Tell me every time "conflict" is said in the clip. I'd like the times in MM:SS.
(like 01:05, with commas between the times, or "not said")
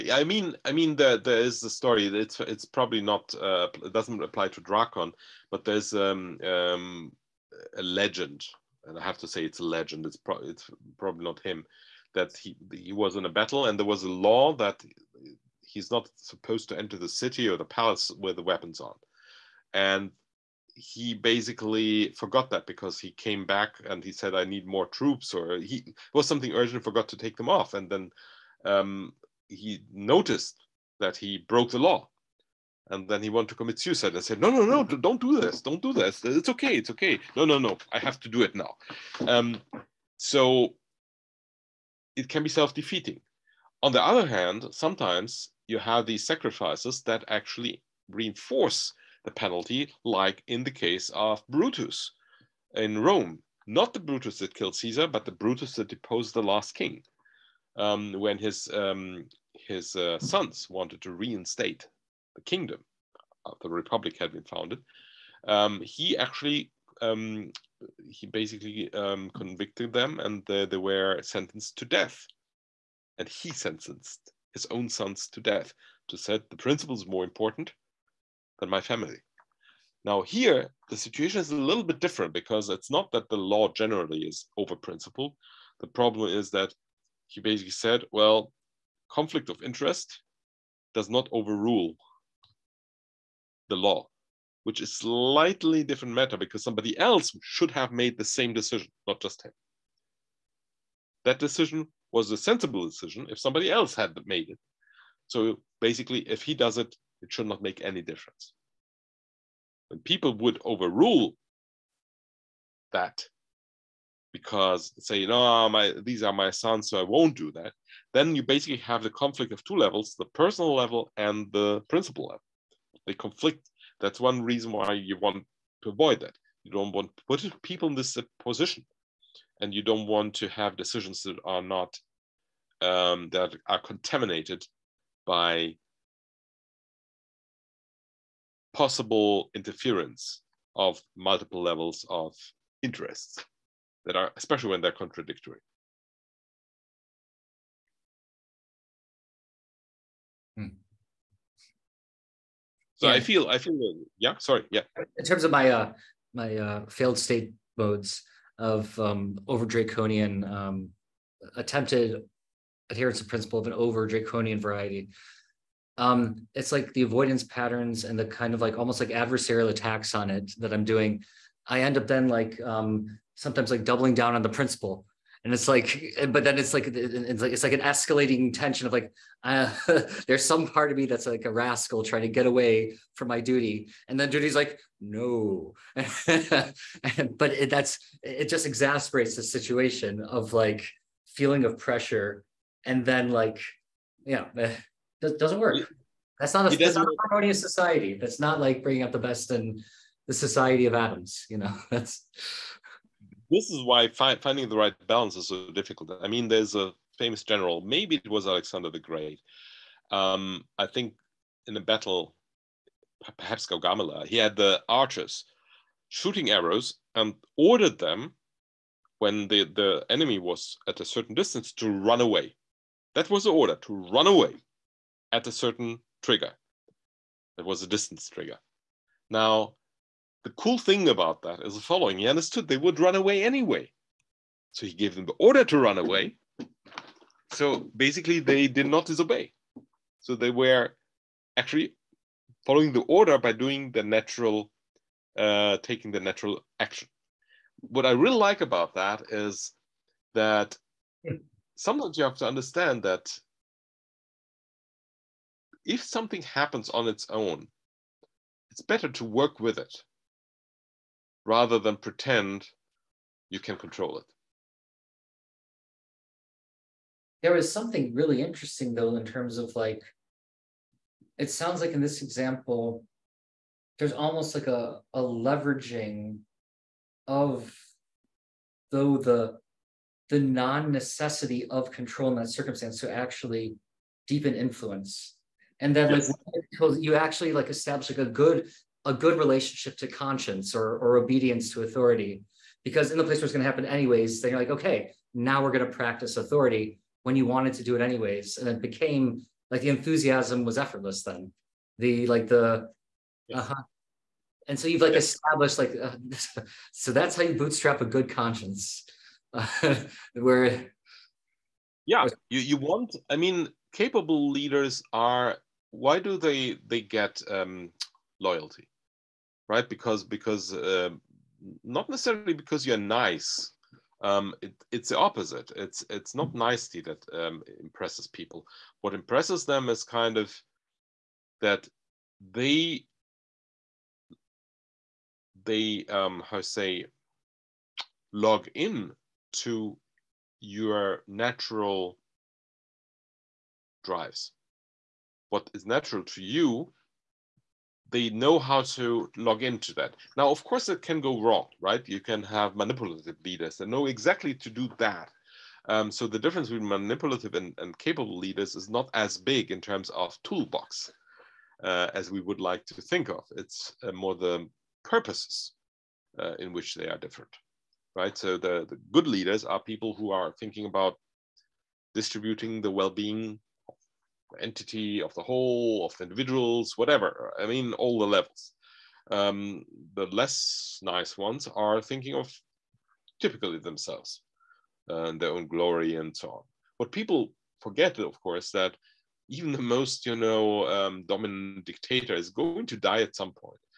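01:29, 01:59, 02:03.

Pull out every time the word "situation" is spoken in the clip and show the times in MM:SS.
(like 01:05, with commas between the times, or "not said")
01:20, 03:09.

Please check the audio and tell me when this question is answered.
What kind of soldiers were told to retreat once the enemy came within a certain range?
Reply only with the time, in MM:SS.
03:34.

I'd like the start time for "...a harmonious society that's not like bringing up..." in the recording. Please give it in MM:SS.
03:17.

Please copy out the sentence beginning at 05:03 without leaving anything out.
uh-huh and so you've like yeah.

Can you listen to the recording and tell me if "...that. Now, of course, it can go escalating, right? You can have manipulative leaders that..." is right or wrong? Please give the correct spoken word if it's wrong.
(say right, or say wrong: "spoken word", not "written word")
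wrong: "wrong", not "escalating".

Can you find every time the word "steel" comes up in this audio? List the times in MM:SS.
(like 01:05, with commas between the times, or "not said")
not said.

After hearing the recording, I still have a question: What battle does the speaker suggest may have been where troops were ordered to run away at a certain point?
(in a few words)
Gaugamela.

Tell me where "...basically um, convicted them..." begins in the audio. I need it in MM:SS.
01:08.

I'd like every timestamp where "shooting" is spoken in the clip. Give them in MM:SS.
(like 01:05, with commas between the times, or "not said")
03:36.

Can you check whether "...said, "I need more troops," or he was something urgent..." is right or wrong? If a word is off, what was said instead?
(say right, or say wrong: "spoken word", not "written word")
right.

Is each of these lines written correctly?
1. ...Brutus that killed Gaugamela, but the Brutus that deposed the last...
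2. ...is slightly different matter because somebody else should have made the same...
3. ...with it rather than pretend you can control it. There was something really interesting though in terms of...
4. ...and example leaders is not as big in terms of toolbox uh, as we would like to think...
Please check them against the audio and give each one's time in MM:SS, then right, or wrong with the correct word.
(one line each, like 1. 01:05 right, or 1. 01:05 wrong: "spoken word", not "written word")
1. 00:54 wrong: "Caesar", not "Gaugamela"
2. 01:34 right
3. 04:19 right
4. 05:57 wrong: "capable", not "example".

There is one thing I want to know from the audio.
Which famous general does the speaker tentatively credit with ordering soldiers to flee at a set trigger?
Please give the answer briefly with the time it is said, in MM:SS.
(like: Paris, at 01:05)
Alexander the Great, at 03:28.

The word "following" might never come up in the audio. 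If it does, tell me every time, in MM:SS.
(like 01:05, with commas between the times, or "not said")
03:51, 04:02.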